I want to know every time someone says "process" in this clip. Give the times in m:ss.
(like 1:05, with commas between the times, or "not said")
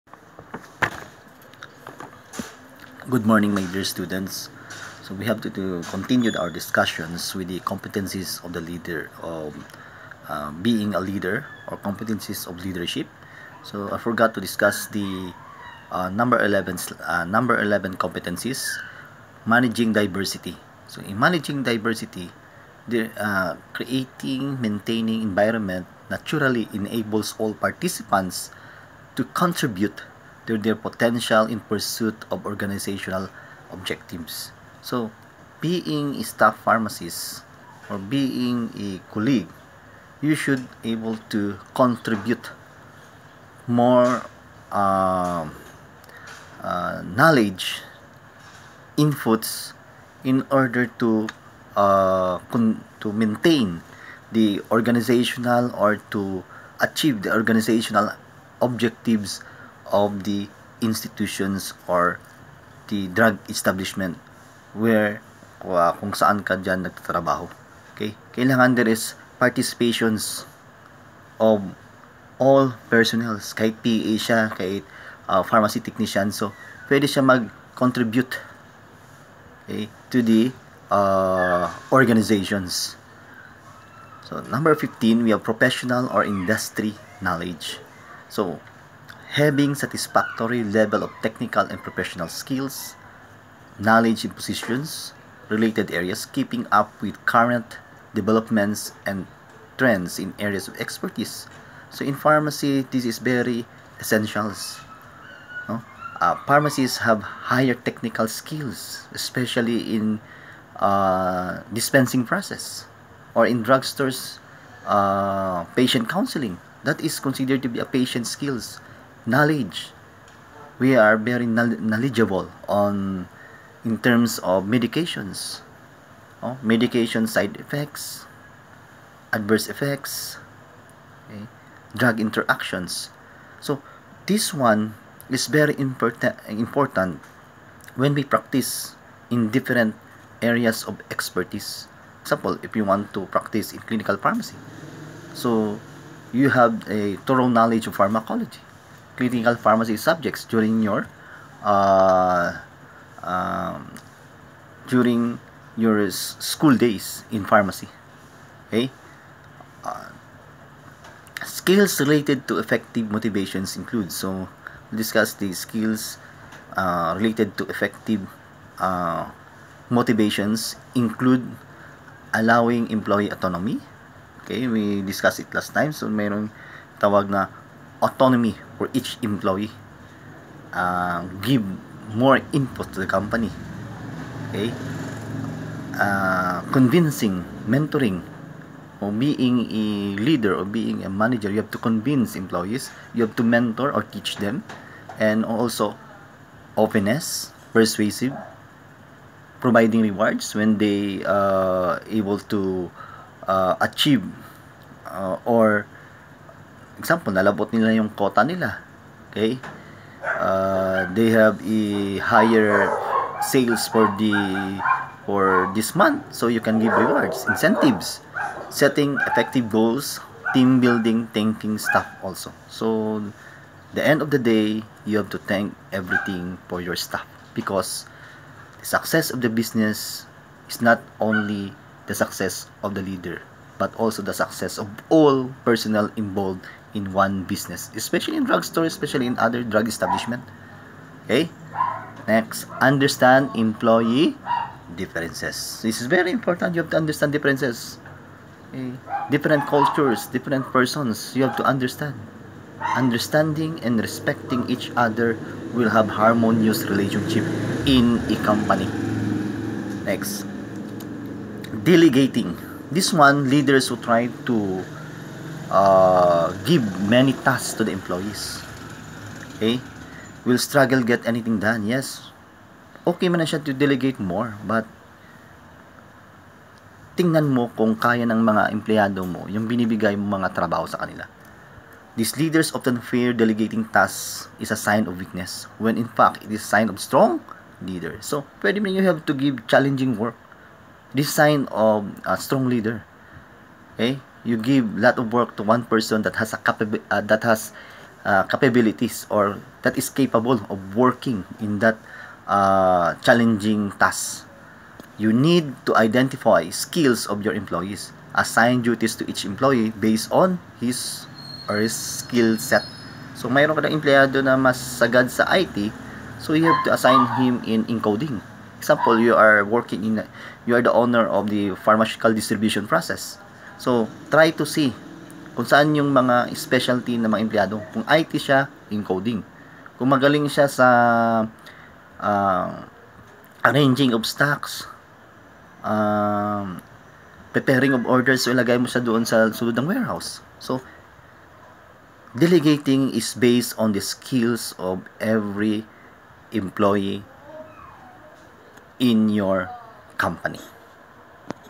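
1:52, 5:22.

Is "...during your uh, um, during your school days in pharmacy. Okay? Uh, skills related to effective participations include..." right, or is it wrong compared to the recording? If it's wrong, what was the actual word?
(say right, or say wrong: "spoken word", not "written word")
wrong: "motivations", not "participations".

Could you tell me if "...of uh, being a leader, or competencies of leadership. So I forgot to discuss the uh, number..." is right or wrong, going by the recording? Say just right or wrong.
right.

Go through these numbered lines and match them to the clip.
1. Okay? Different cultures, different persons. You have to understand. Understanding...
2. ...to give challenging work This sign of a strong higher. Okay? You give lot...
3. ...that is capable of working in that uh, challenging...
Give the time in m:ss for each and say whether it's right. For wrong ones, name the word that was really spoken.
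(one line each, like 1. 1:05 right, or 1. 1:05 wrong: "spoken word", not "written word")
1. 4:08 right
2. 4:49 wrong: "leader", not "higher"
3. 4:59 right.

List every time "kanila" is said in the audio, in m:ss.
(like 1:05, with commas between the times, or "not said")
4:41.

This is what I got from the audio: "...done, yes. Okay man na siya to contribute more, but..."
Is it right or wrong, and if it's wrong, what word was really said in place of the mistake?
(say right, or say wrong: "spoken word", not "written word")
wrong: "delegate", not "contribute".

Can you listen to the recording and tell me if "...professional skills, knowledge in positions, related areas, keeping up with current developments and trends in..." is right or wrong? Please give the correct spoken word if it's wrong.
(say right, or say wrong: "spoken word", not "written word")
right.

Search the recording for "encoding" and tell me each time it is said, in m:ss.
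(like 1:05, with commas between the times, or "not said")
5:17, 5:28.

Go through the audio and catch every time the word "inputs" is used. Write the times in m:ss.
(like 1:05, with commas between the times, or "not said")
0:48, 3:02.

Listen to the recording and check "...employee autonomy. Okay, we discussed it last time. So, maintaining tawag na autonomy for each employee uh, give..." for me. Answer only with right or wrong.
wrong.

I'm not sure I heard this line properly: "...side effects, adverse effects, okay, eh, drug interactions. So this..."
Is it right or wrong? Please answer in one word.
right.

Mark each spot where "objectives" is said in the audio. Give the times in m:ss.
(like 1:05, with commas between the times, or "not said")
0:33, 0:58.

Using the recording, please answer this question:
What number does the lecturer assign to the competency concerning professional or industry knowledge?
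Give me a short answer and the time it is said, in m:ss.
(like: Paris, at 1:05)
15, at 1:24.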